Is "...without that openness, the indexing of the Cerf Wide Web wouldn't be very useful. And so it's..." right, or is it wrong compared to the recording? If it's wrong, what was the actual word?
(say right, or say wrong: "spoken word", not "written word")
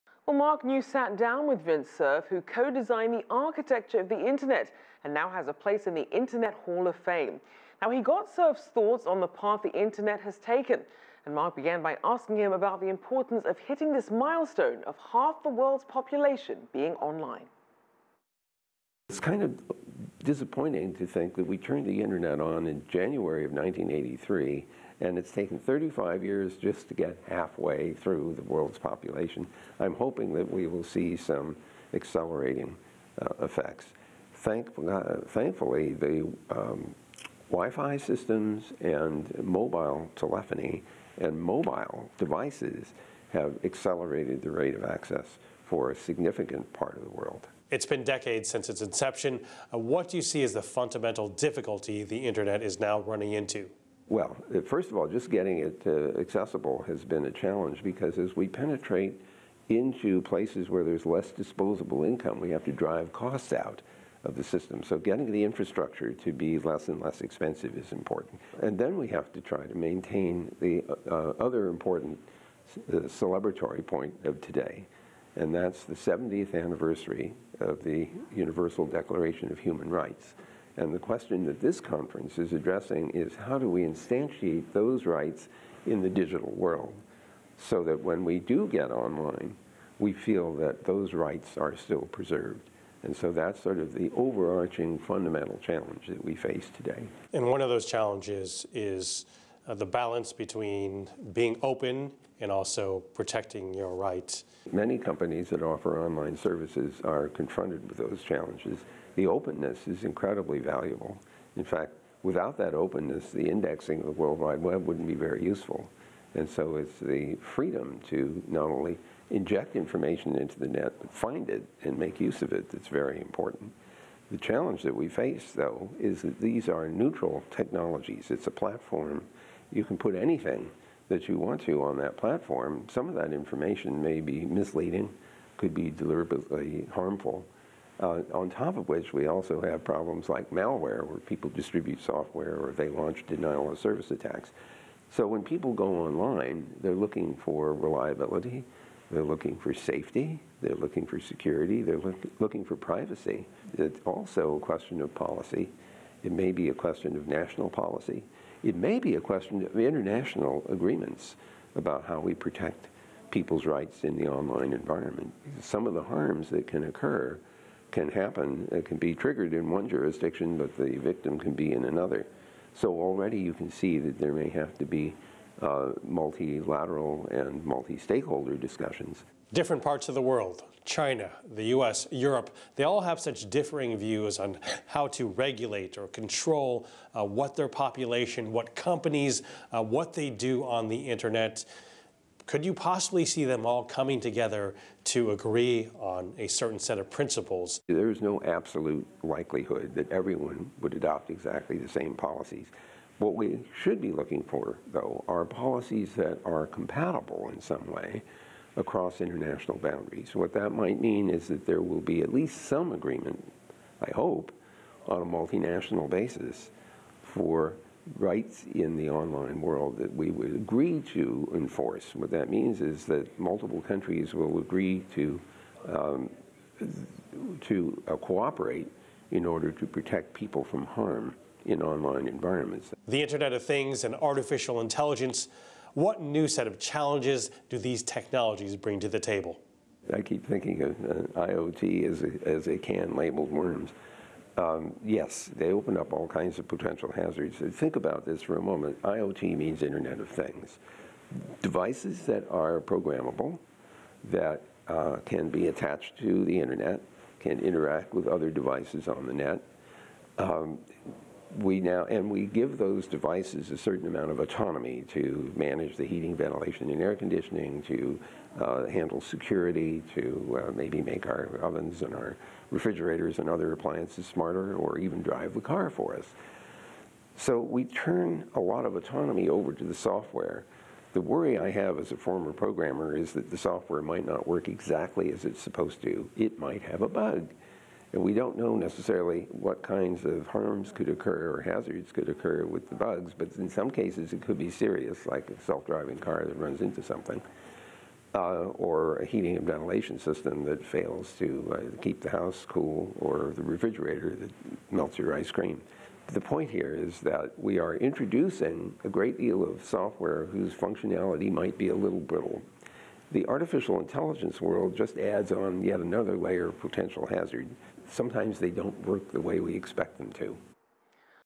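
wrong: "World", not "Cerf".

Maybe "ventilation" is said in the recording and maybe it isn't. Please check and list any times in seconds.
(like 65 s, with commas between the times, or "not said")
266 s, 299 s.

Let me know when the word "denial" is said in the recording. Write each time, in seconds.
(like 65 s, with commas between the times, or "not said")
143 s.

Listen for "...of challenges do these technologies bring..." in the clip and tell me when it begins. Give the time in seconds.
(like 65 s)
236 s.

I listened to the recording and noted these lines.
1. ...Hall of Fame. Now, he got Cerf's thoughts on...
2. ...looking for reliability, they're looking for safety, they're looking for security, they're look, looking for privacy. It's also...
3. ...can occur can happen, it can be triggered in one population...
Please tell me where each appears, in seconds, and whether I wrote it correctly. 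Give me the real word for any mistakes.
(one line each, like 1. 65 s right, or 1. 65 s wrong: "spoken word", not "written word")
1. 6 s right
2. 146 s right
3. 166 s wrong: "jurisdiction", not "population".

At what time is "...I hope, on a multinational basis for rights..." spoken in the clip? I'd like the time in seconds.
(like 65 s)
214 s.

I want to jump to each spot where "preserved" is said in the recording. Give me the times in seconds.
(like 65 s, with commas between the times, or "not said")
92 s.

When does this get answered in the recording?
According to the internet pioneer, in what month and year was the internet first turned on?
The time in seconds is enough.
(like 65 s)
22 s.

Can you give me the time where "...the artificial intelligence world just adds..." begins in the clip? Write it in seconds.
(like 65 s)
313 s.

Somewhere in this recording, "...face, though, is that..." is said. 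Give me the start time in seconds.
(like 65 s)
125 s.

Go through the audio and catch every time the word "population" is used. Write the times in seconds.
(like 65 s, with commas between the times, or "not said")
15 s, 28 s, 187 s.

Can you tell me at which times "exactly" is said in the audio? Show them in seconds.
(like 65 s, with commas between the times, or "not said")
201 s, 284 s.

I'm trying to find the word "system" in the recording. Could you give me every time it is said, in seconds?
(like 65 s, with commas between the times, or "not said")
37 s, 64 s, 300 s.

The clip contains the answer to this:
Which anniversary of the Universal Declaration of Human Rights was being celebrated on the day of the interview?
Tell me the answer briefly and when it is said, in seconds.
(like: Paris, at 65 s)
70th, at 75 s.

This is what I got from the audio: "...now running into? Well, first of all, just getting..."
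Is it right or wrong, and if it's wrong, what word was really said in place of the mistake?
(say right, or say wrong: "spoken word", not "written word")
right.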